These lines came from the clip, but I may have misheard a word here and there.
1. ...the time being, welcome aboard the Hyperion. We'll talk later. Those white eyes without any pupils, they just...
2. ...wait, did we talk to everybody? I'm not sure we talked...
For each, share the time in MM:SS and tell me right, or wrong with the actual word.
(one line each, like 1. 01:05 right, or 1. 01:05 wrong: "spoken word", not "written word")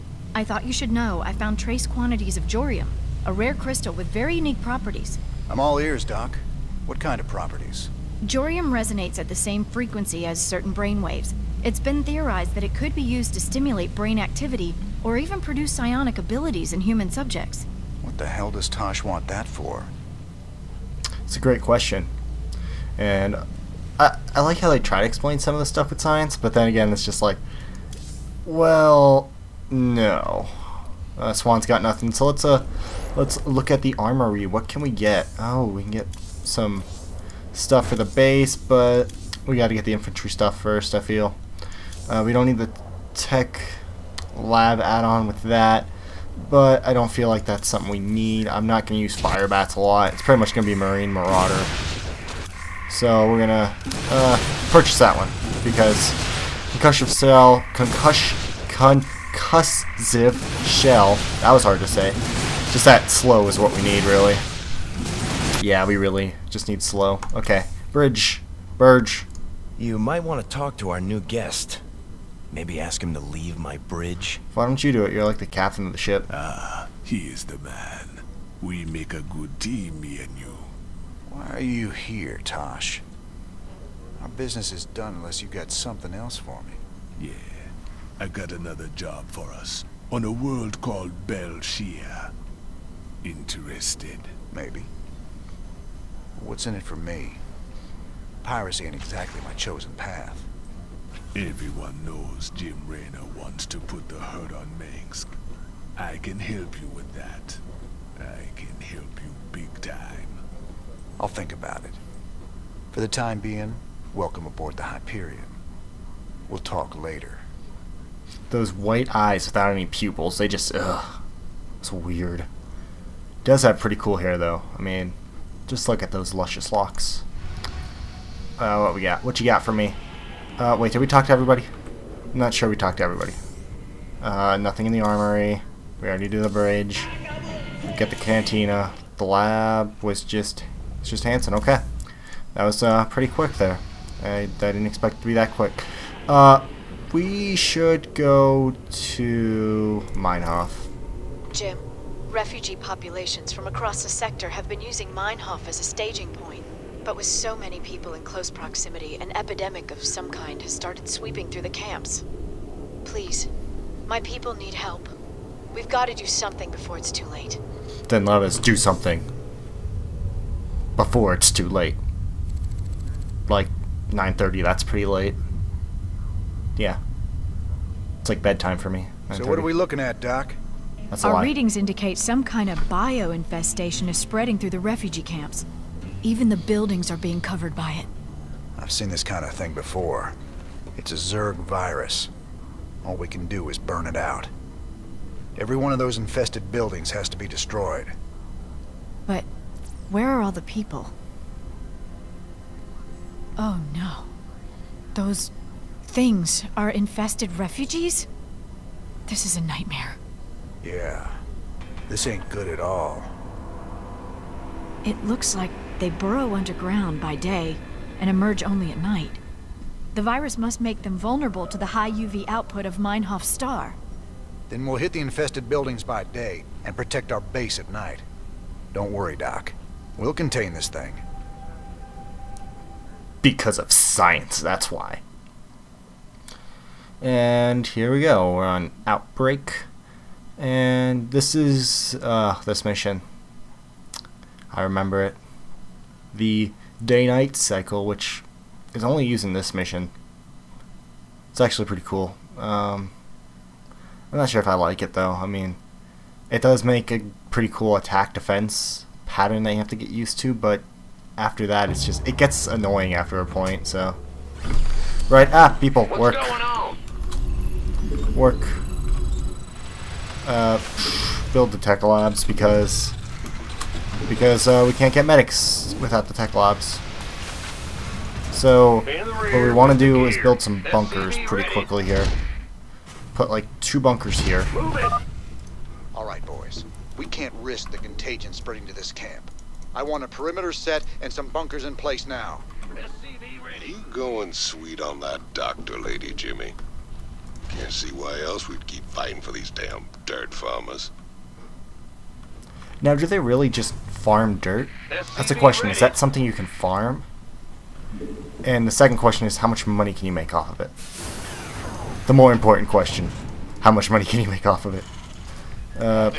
1. 01:53 right
2. 02:10 right.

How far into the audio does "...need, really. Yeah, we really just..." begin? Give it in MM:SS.
01:03.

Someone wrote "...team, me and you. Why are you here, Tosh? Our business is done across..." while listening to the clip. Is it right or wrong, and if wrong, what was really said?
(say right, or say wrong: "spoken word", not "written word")
wrong: "unless", not "across".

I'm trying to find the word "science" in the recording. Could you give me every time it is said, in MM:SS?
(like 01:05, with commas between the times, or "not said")
00:26, 03:53.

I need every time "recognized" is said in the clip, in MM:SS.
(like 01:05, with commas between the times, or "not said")
not said.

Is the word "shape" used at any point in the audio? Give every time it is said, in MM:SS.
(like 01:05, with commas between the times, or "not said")
not said.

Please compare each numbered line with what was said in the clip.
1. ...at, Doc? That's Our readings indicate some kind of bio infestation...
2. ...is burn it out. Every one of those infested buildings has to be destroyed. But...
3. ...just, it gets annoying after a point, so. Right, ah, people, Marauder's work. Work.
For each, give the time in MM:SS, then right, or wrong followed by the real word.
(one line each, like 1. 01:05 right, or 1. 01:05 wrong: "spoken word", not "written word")
1. 03:00 right
2. 03:13 right
3. 04:22 wrong: "What", not "Marauder".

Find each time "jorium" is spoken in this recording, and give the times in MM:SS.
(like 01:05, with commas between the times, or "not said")
00:02, 00:08.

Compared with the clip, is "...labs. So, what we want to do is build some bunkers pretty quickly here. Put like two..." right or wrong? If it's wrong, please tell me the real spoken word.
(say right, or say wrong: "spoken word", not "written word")
right.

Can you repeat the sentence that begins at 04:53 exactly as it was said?
You going sweet on that doctor lady, Jimmy?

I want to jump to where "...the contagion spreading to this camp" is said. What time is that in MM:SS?
04:47.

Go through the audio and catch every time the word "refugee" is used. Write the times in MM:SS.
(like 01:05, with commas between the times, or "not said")
02:32, 03:04, 03:27.